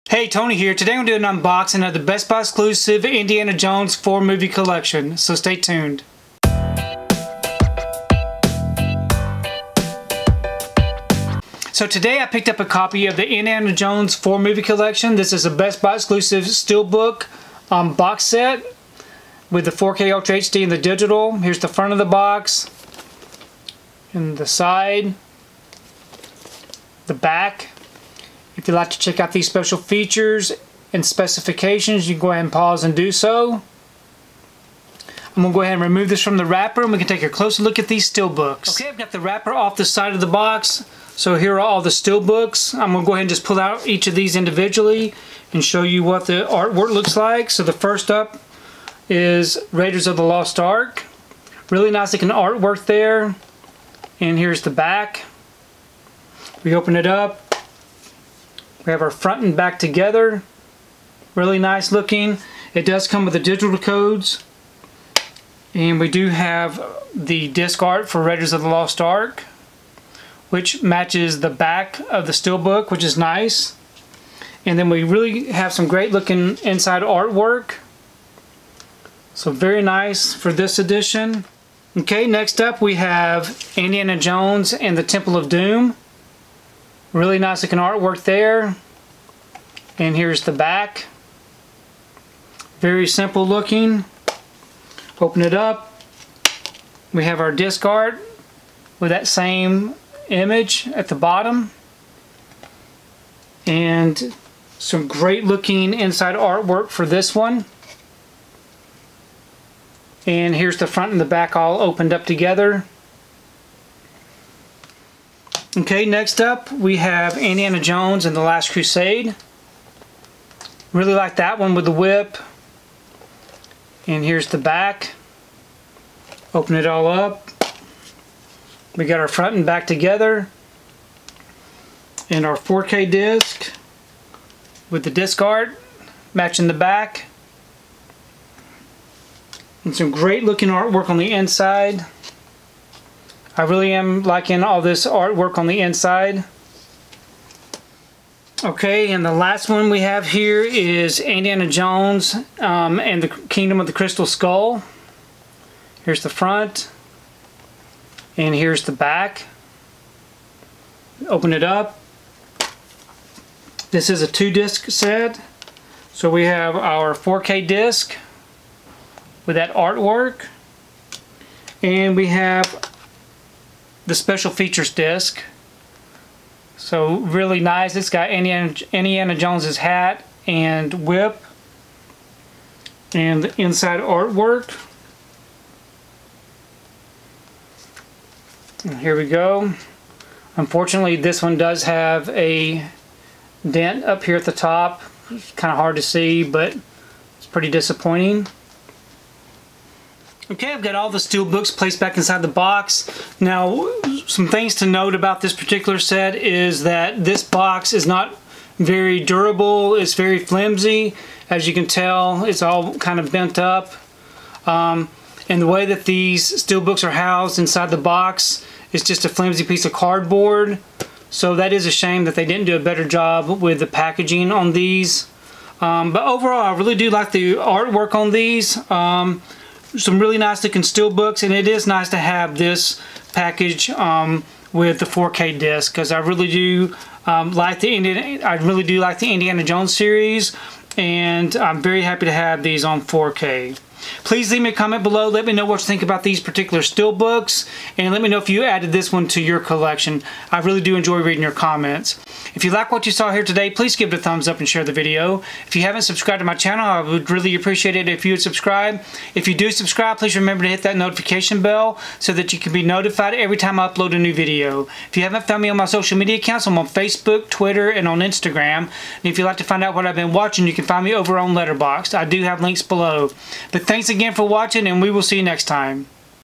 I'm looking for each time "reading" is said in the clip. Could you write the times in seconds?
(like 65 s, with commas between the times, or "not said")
251 s.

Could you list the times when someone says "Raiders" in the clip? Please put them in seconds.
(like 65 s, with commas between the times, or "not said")
49 s, 68 s.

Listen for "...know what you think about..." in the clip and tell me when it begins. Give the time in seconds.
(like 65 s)
245 s.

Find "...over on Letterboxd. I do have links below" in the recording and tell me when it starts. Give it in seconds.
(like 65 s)
271 s.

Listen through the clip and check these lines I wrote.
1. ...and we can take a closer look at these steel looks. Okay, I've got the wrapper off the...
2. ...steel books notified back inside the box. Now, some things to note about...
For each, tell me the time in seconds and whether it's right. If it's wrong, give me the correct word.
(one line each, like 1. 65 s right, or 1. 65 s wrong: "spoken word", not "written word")
1. 36 s wrong: "books", not "looks"
2. 201 s wrong: "placed", not "notified".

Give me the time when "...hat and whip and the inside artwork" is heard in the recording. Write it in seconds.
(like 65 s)
179 s.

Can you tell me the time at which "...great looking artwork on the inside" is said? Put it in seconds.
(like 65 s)
140 s.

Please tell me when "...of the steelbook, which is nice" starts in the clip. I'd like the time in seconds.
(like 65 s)
72 s.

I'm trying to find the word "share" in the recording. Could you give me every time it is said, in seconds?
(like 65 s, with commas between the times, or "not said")
254 s.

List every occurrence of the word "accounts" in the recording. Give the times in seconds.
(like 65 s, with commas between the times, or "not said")
266 s.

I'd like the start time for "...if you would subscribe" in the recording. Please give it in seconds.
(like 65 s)
258 s.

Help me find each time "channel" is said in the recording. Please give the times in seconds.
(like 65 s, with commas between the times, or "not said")
256 s.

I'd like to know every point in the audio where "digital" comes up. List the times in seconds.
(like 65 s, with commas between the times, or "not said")
20 s, 63 s.